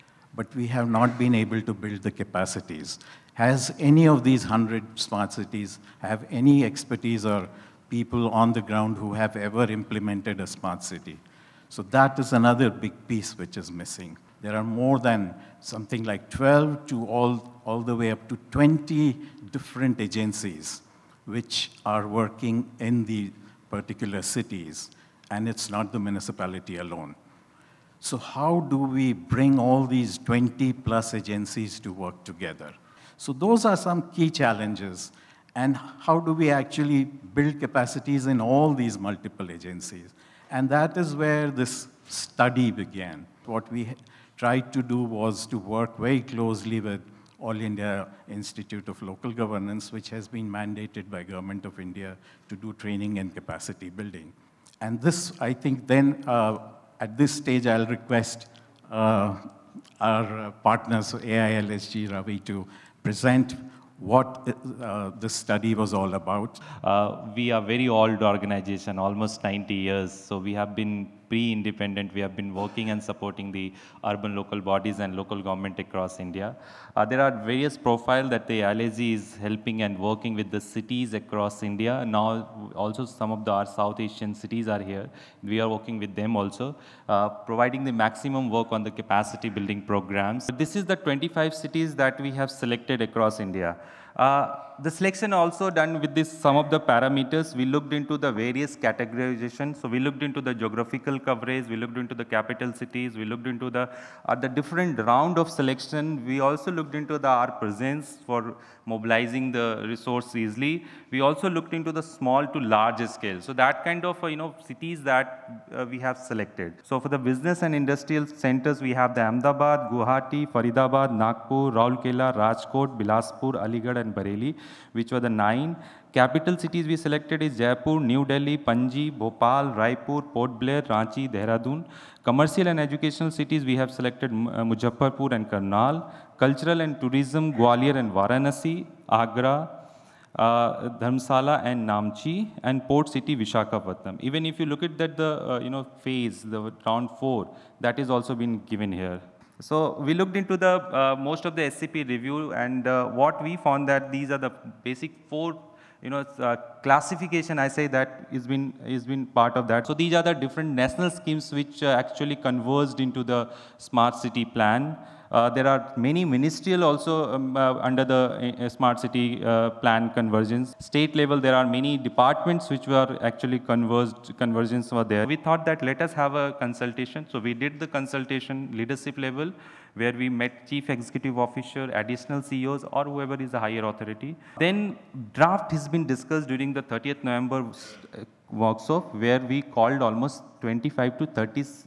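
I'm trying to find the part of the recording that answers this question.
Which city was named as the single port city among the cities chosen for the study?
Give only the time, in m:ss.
2:23.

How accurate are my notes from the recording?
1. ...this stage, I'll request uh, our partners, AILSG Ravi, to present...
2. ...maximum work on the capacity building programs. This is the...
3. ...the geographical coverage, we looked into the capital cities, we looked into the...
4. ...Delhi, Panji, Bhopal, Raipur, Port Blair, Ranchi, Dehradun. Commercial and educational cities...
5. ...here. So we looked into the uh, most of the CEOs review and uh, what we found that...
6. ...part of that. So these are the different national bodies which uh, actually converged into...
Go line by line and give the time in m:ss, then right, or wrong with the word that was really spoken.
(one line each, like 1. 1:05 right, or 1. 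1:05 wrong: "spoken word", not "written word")
1. 0:57 right
2. 1:27 right
3. 1:40 right
4. 2:08 right
5. 2:28 wrong: "SCP", not "CEOs"
6. 2:39 wrong: "schemes", not "bodies".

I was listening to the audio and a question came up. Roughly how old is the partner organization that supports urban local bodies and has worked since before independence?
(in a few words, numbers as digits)
90 years.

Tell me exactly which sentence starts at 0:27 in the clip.
So how do we bring all these 20 plus agencies to work together?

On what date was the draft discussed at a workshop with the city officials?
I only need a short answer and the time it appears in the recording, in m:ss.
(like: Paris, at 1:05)
30th November, at 3:06.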